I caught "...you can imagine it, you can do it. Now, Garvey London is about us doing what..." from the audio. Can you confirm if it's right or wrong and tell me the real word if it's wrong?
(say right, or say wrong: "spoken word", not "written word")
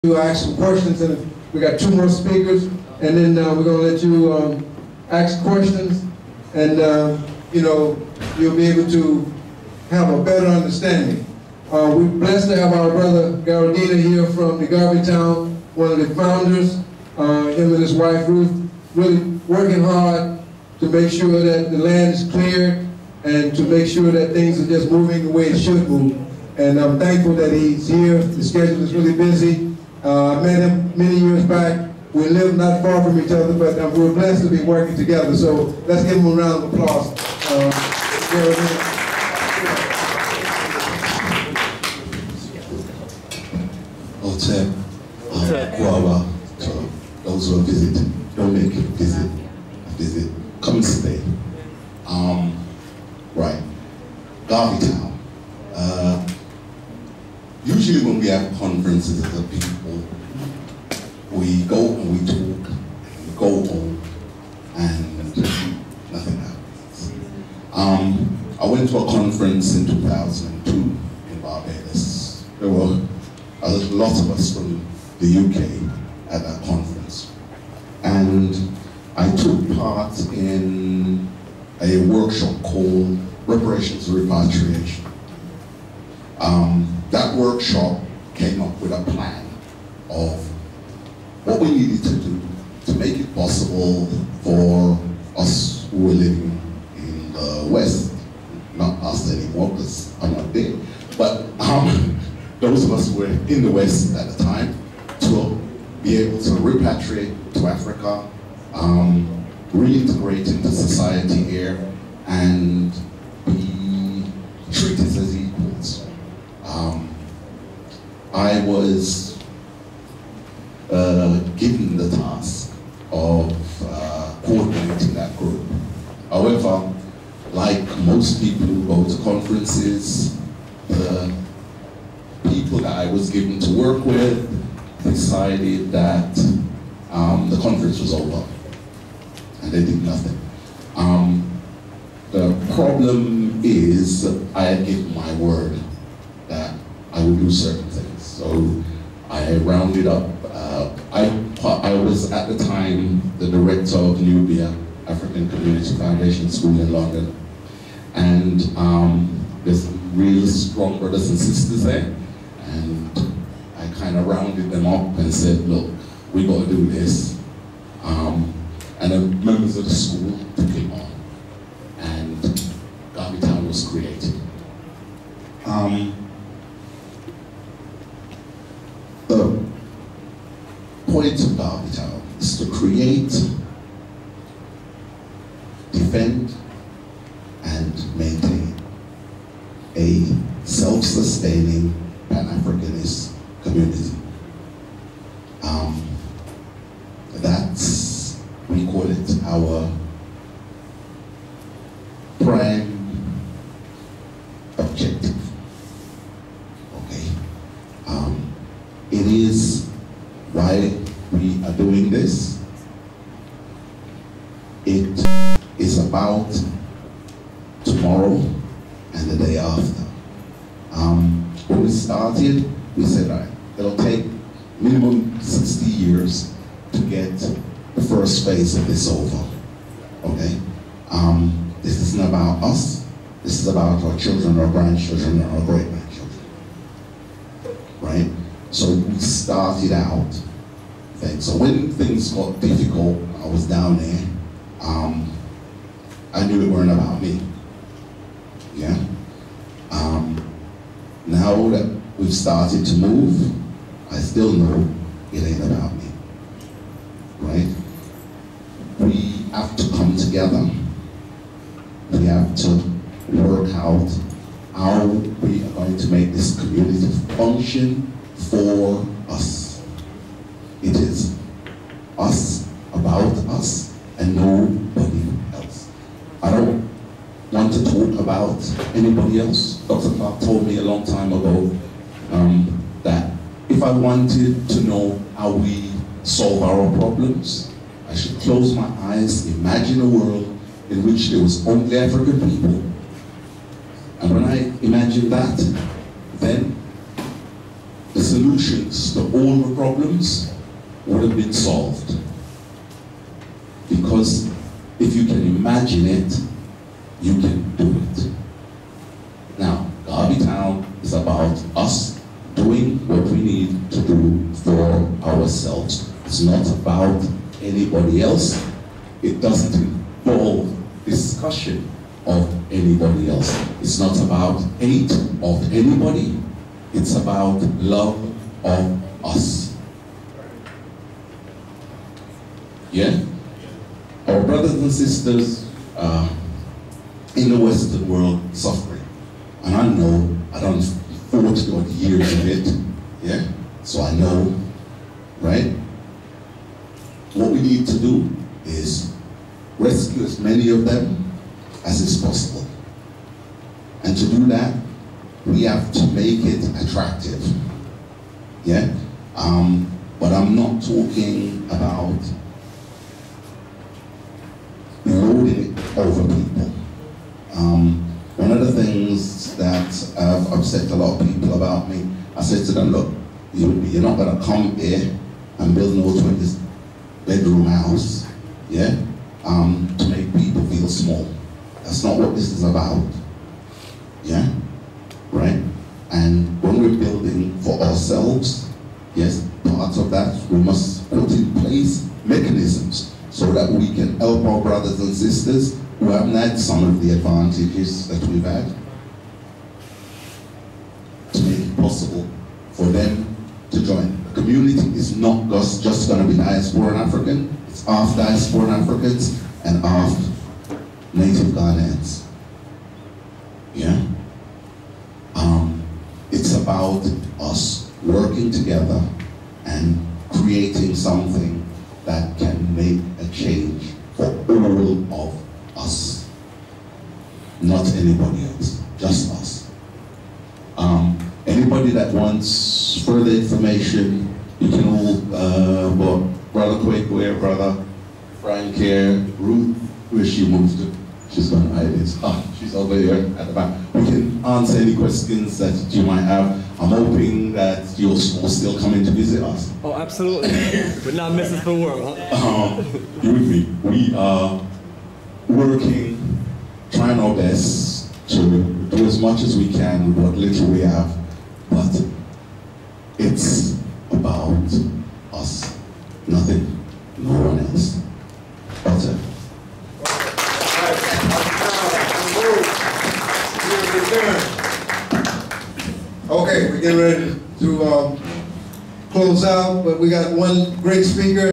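wrong: "Town", not "London".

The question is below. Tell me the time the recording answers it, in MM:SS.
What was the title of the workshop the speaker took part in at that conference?
01:23.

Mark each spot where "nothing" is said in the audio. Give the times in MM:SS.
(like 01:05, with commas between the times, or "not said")
01:06, 02:20, 07:46.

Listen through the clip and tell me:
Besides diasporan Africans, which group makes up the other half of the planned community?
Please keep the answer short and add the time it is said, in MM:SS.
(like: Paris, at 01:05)
native Ghanaians, at 06:51.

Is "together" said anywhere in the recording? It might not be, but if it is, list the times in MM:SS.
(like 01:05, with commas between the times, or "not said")
00:34, 04:20, 06:58.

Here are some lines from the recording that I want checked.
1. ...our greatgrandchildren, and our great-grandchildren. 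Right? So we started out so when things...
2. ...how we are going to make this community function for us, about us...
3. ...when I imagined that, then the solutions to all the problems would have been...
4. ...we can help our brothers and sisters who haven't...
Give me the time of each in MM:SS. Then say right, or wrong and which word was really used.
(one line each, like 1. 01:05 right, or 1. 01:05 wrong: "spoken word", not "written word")
1. 03:54 wrong: "grandchildren", not "greatgrandchildren"
2. 04:24 right
3. 04:54 right
4. 06:33 right.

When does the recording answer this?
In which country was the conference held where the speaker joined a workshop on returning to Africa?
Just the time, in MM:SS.
01:11.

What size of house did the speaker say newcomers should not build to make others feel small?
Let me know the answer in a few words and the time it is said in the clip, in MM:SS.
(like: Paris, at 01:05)
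20 bedroom, at 06:16.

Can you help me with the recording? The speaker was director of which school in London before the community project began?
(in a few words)
Nubia African Community Foundation School.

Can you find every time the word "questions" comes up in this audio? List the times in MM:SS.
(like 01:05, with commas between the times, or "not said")
00:00, 00:05, 07:24.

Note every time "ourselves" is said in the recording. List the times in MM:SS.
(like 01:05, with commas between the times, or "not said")
05:15, 06:27.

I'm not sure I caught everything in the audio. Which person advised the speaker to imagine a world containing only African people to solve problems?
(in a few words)
Dr. Clark.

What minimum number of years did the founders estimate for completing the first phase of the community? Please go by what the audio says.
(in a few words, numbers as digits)
60.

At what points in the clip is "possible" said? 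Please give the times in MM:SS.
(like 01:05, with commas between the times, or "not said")
01:33, 05:52, 06:41.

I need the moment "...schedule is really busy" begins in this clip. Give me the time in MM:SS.
00:28.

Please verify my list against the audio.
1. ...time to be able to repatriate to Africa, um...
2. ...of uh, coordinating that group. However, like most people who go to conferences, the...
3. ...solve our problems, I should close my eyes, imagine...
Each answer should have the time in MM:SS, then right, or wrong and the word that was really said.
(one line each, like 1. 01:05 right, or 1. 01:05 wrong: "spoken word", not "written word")
1. 01:44 right
2. 02:03 right
3. 04:46 right.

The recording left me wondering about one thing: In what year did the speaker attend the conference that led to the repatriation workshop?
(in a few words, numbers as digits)
2002.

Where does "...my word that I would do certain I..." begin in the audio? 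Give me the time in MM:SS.
02:25.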